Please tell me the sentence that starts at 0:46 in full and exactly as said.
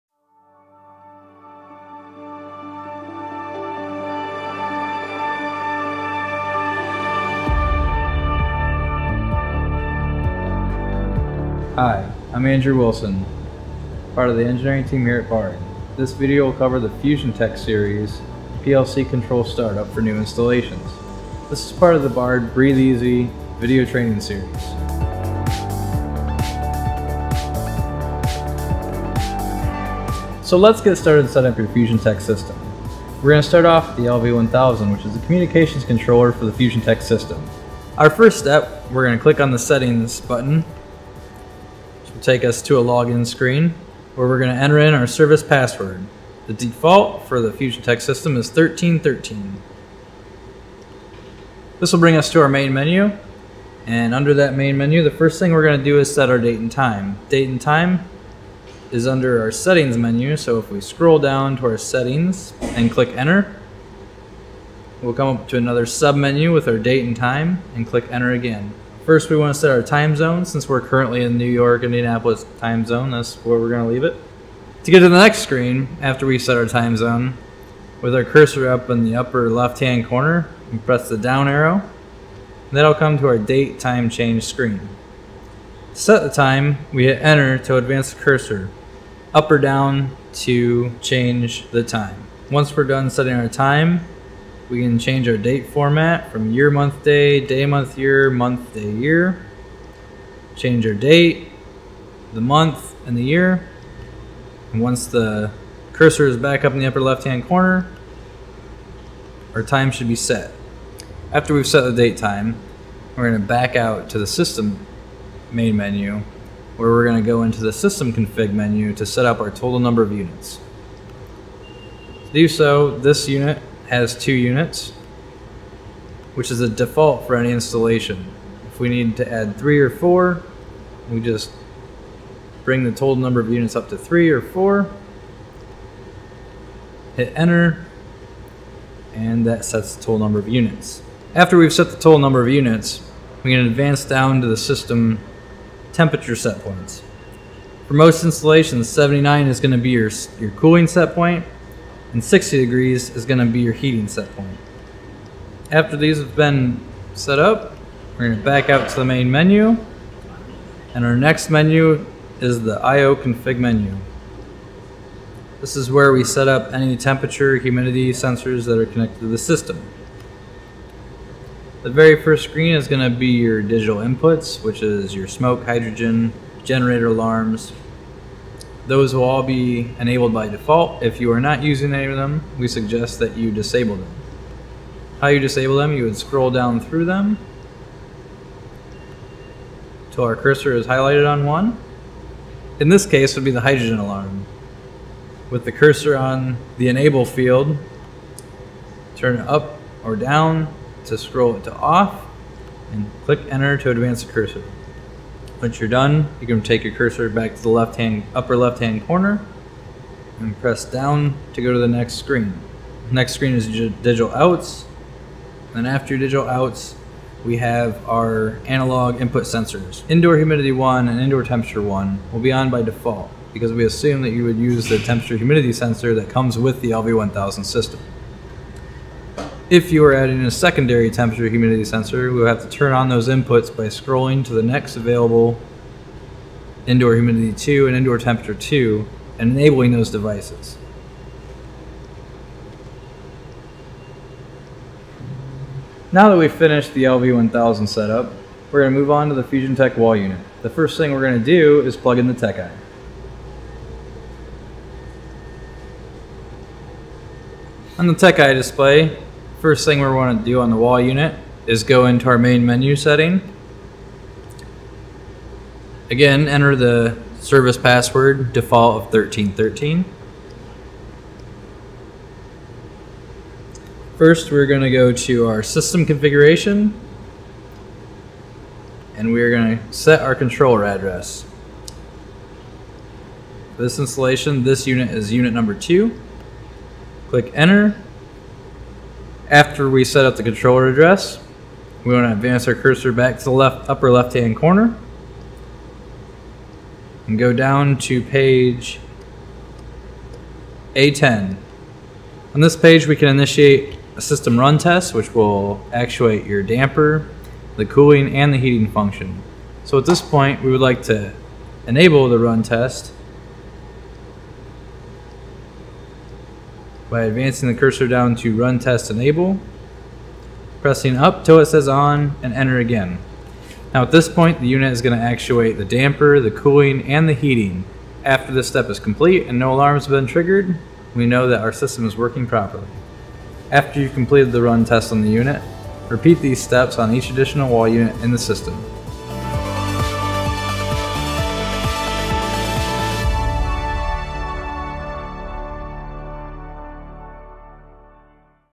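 The default for the FUSION-TEC system is 1313.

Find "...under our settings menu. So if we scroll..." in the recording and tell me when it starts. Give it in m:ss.
0:59.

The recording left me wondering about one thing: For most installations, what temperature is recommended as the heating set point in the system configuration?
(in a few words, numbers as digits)
60 degrees.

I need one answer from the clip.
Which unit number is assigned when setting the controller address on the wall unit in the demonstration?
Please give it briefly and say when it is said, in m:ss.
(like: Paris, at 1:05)
2, at 4:45.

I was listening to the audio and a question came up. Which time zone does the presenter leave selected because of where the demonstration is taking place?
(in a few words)
New York, Indianapolis.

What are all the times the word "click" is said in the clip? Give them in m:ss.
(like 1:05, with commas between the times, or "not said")
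0:39, 1:02, 1:07, 3:23, 4:47.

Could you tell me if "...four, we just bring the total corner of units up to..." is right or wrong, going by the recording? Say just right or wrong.
wrong.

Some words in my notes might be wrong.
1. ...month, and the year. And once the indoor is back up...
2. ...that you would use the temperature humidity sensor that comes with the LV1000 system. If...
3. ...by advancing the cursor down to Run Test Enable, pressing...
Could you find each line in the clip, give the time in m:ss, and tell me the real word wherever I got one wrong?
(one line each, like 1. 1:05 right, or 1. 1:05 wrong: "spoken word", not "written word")
1. 1:42 wrong: "cursor", not "indoor"
2. 3:44 right
3. 5:17 right.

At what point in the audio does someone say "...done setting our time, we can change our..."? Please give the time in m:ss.
1:32.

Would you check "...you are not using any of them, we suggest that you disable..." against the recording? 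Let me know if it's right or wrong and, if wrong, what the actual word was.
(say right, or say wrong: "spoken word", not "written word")
right.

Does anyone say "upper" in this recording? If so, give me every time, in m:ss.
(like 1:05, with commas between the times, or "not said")
1:19, 1:46, 3:28, 4:53.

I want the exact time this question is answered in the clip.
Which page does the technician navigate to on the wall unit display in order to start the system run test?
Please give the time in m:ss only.
4:58.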